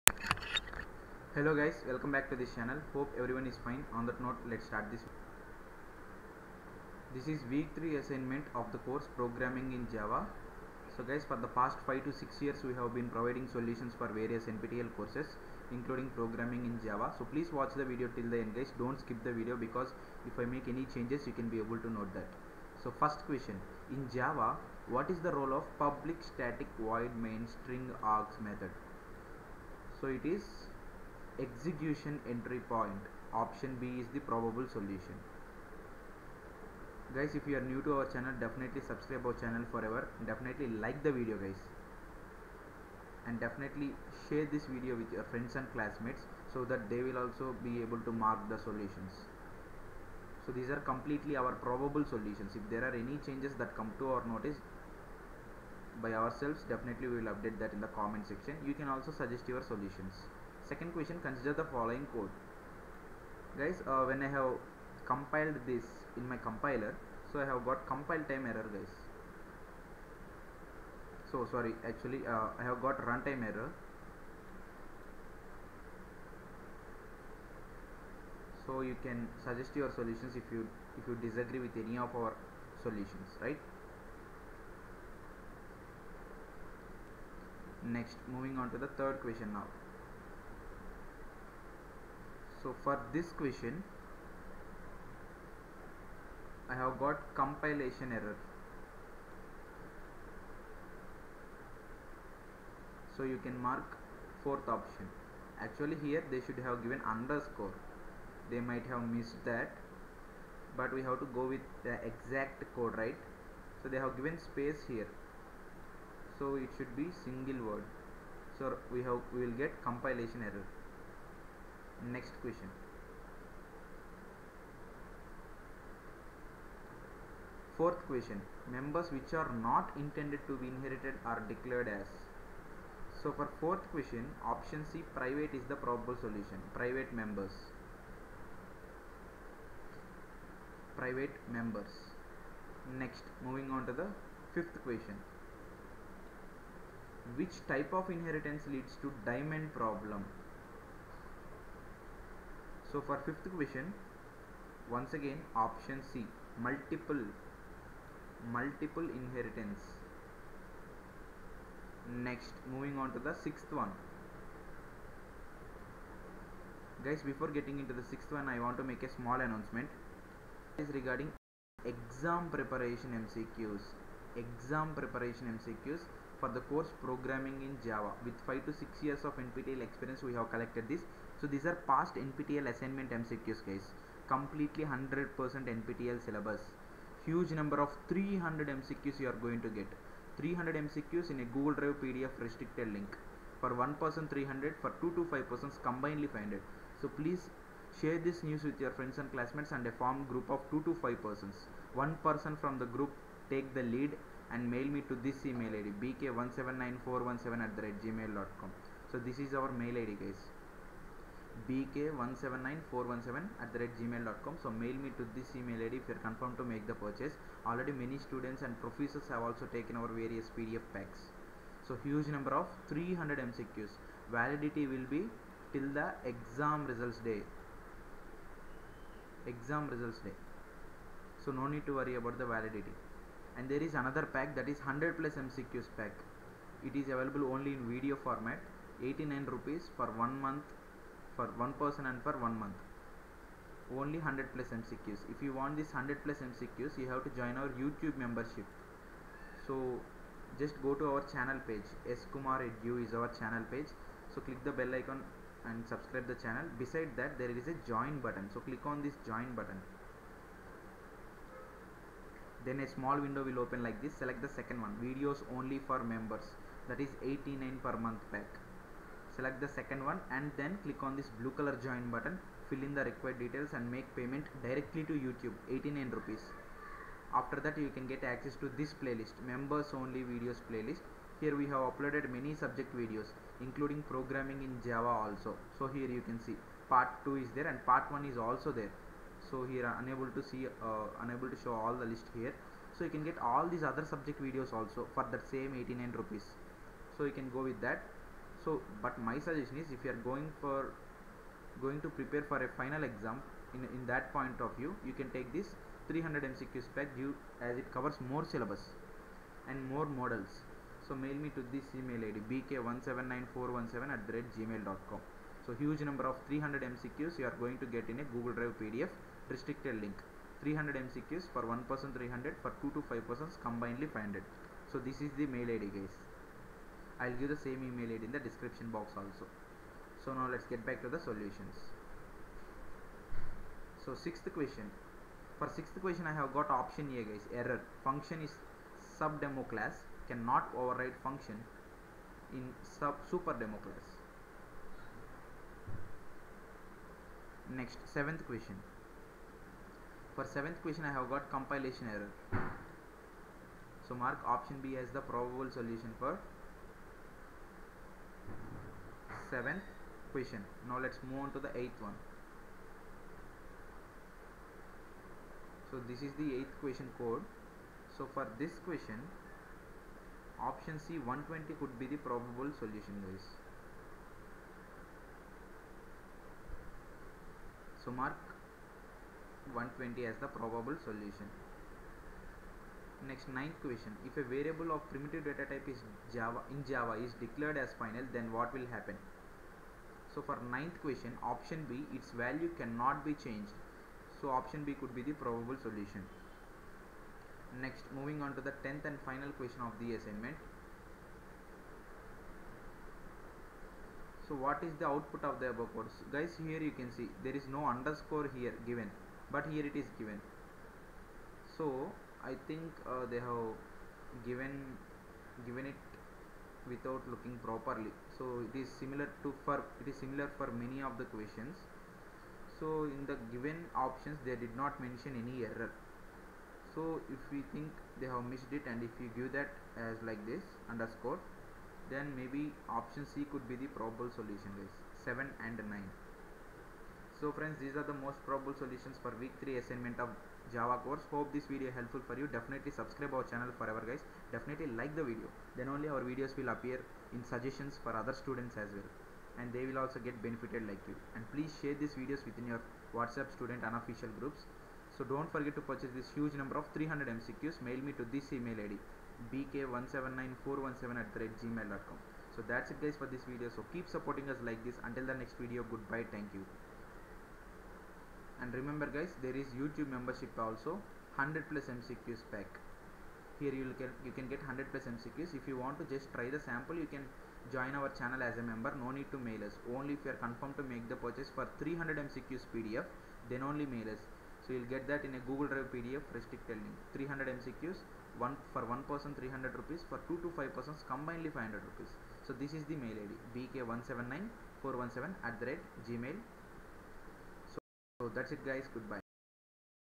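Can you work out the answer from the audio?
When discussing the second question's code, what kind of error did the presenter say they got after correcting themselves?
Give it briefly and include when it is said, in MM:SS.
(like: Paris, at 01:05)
runtime error, at 01:13.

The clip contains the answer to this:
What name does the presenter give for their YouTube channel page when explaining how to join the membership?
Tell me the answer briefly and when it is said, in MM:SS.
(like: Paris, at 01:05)
S Kumar Edu, at 04:12.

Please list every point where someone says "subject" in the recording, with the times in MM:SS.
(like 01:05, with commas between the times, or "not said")
04:42, 04:54.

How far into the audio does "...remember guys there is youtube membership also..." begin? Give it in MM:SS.
07:48.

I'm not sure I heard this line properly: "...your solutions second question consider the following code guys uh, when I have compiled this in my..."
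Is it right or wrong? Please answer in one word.
right.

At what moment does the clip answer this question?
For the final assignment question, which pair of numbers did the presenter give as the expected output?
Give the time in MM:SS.
07:15.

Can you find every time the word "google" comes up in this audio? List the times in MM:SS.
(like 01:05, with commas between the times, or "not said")
03:11, 05:18, 08:05.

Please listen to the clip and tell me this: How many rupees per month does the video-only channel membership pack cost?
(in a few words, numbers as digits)
89.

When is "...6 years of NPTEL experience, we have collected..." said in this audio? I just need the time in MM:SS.
02:58.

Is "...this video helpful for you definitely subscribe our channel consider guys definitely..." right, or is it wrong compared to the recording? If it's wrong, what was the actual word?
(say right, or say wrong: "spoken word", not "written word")
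wrong: "forever", not "consider".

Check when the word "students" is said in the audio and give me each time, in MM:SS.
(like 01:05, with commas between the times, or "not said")
03:38, 07:28, 07:33.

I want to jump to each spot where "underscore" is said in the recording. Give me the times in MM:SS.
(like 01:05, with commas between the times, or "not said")
01:47, 06:47, 07:10.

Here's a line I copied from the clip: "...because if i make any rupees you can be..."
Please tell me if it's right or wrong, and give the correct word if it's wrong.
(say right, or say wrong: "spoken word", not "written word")
wrong: "changes", not "rupees".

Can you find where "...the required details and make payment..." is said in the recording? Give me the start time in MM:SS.
04:32.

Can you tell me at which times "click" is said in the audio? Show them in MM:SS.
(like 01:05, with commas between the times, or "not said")
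04:14, 04:18, 04:30.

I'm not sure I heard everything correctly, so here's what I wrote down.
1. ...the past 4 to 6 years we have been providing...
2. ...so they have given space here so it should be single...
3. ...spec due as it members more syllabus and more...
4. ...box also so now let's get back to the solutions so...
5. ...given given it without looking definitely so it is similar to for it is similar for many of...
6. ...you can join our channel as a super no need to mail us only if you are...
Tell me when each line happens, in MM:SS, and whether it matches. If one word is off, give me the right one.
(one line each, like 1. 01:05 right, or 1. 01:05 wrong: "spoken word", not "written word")
1. 00:11 wrong: "5", not "4"
2. 01:53 right
3. 05:06 wrong: "covers", not "members"
4. 05:28 right
5. 06:54 wrong: "properly", not "definitely"
6. 07:57 wrong: "member", not "super".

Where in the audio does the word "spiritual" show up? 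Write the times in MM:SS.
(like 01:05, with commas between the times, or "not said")
not said.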